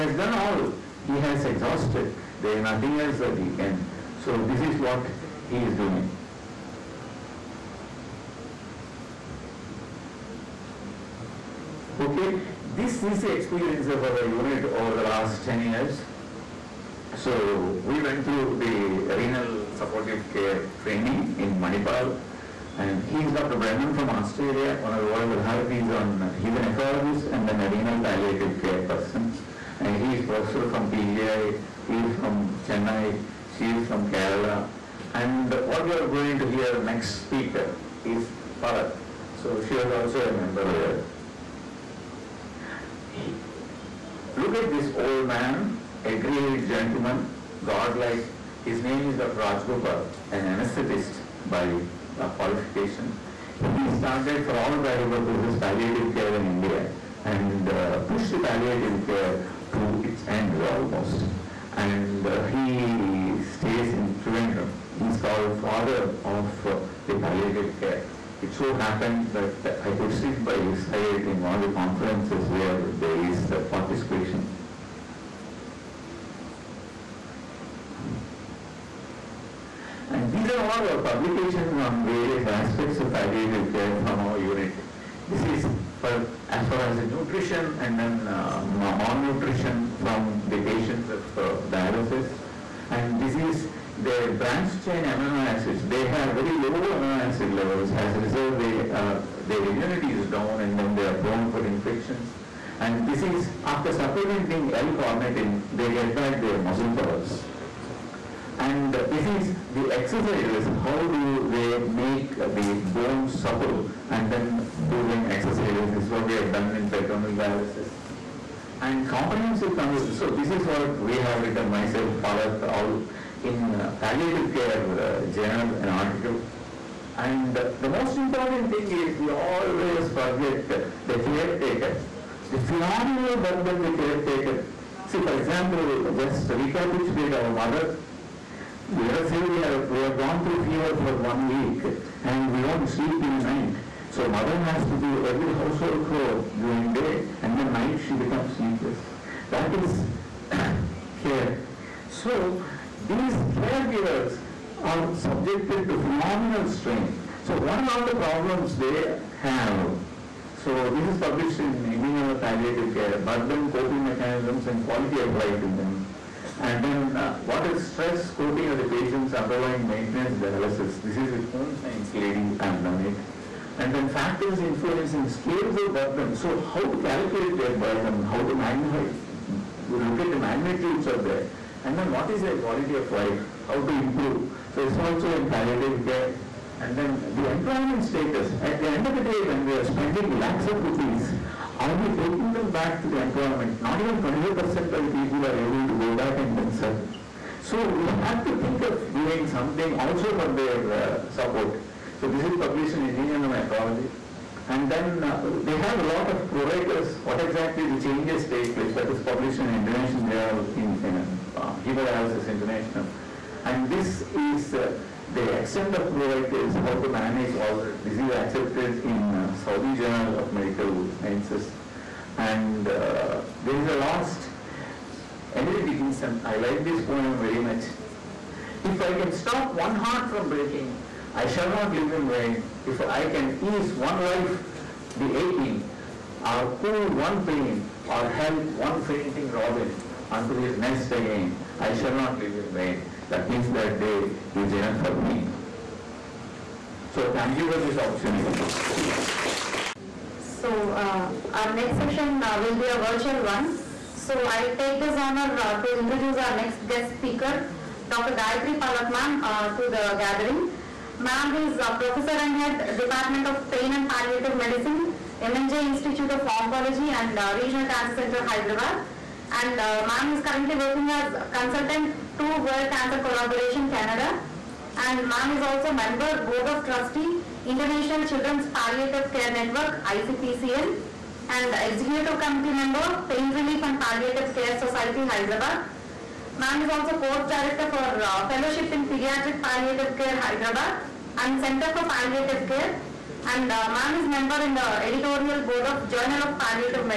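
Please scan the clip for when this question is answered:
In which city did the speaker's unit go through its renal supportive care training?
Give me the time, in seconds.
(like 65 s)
21 s.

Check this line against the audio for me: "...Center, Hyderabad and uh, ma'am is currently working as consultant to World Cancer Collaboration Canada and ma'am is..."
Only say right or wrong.
right.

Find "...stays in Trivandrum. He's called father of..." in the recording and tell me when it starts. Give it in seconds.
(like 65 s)
63 s.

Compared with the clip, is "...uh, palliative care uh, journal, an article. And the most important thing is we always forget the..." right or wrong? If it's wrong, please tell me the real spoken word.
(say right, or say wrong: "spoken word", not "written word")
right.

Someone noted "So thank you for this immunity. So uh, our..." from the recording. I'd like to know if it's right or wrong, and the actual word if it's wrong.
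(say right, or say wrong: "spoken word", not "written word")
wrong: "opportunity", not "immunity".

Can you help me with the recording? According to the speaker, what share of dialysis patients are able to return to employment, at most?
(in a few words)
25%.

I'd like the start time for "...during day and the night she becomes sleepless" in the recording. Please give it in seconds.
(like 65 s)
146 s.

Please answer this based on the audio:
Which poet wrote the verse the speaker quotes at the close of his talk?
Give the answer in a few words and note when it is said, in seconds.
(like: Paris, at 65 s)
Emily Dickinson, at 225 s.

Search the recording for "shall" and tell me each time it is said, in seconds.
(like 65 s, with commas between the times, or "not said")
231 s, 241 s.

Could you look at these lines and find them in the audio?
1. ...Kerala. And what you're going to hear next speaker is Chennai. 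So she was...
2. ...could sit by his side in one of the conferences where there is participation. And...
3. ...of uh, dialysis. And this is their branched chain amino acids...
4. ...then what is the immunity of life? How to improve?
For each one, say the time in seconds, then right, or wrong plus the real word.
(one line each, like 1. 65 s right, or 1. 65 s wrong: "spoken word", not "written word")
1. 34 s wrong: "Palat", not "Chennai"
2. 69 s right
3. 91 s right
4. 181 s wrong: "quality", not "immunity".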